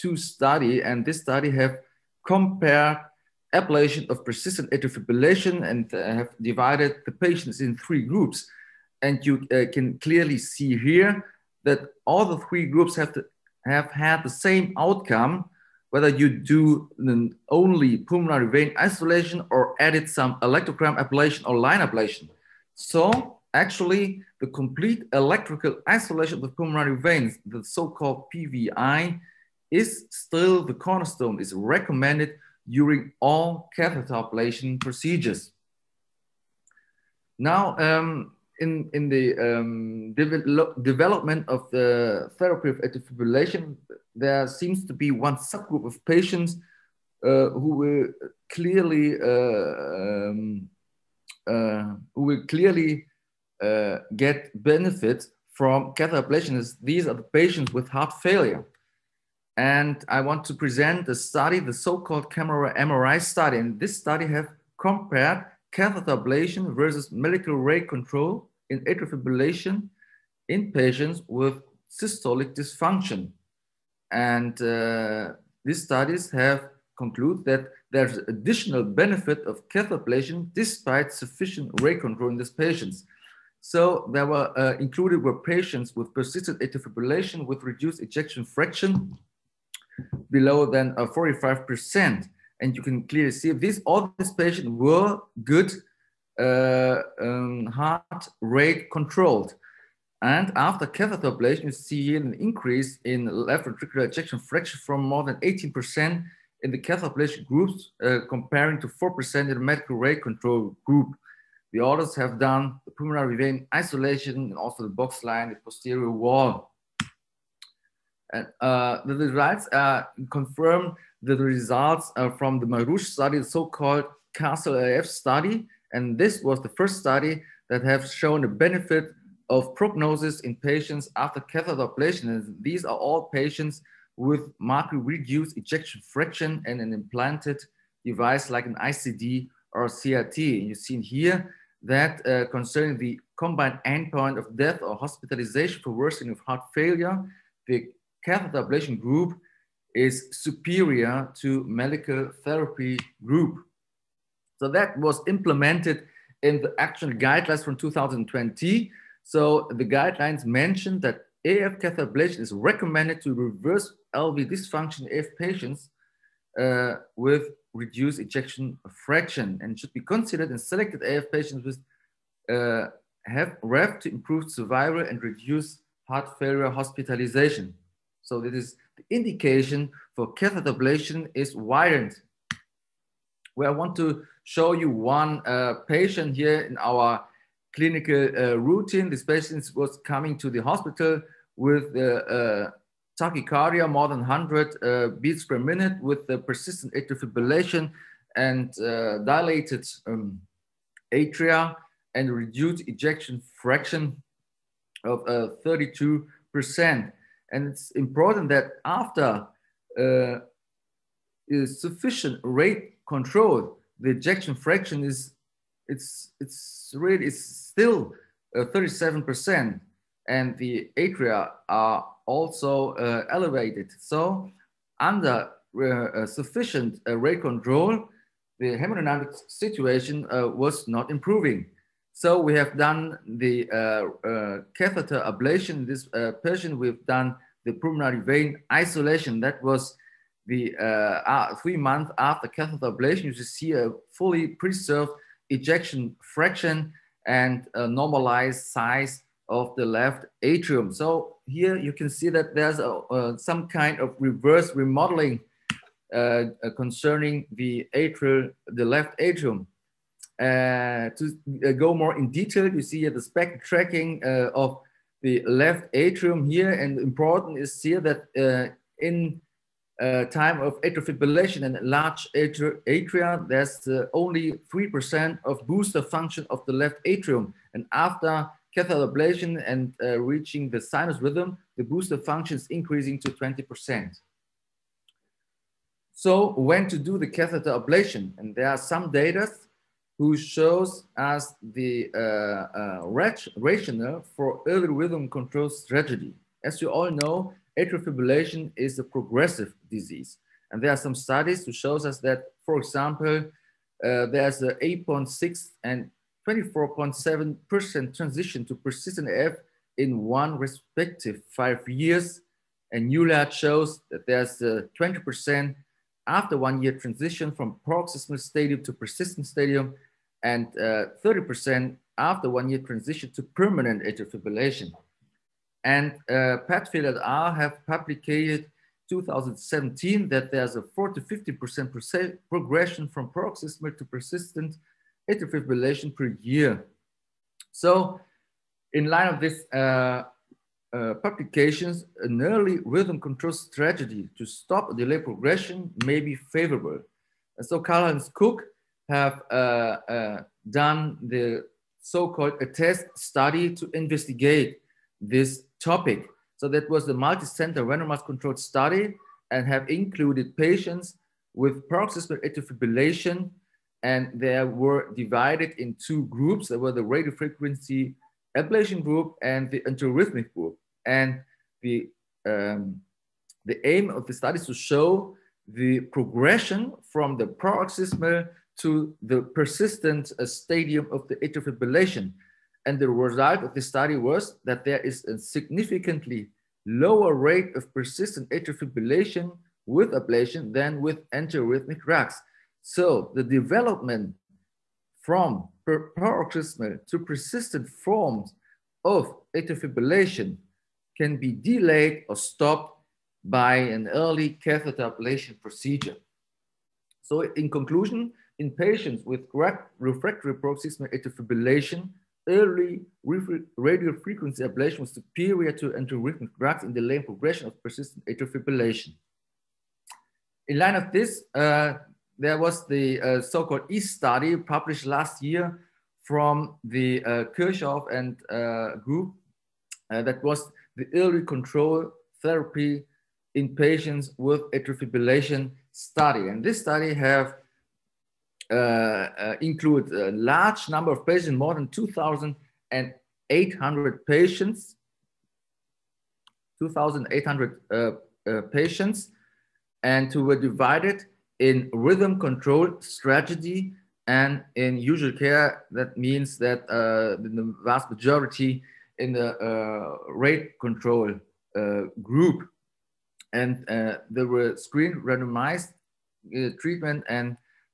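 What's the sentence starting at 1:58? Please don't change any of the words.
And, uh, the results uh, confirm the results uh, from the Marrouche study, the so-called Castle AF study.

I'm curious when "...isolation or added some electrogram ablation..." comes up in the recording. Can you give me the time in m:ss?
0:18.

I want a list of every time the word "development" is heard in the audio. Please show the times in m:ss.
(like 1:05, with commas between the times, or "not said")
0:40, 6:33.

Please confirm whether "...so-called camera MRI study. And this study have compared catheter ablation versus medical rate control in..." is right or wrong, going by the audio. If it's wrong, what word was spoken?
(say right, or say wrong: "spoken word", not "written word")
right.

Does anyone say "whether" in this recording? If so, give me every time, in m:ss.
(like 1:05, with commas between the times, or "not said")
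0:15.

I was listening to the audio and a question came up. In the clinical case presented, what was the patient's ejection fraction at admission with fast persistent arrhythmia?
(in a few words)
32%.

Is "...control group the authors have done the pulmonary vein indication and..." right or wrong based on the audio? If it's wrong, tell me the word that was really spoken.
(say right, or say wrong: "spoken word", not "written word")
wrong: "isolation", not "indication".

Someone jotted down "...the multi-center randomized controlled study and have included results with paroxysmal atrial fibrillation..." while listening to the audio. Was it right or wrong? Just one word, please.
wrong.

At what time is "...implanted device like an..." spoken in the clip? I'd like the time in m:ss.
2:16.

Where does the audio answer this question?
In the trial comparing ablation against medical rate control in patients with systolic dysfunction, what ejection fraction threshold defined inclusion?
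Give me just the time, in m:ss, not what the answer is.
1:30.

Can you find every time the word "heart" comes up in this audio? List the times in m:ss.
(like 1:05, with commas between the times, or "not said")
0:57, 1:37, 2:26, 2:56.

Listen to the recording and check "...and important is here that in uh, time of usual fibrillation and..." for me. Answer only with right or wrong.
wrong.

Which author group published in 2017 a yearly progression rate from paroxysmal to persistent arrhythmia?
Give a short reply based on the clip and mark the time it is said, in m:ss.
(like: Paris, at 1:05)
Padfield et al., at 5:26.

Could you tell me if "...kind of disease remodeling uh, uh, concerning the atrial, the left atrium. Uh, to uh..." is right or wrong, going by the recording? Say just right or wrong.
wrong.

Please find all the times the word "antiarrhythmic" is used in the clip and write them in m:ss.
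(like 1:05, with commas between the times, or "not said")
6:09, 6:31, 6:55.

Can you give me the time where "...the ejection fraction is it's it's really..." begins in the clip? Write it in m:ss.
3:33.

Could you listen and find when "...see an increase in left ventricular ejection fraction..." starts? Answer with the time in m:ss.
1:41.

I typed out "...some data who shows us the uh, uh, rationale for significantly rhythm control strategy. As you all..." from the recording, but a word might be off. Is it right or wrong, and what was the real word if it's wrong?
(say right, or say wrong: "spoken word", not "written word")
wrong: "early", not "significantly".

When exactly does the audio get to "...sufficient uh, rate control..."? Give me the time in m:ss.
3:46.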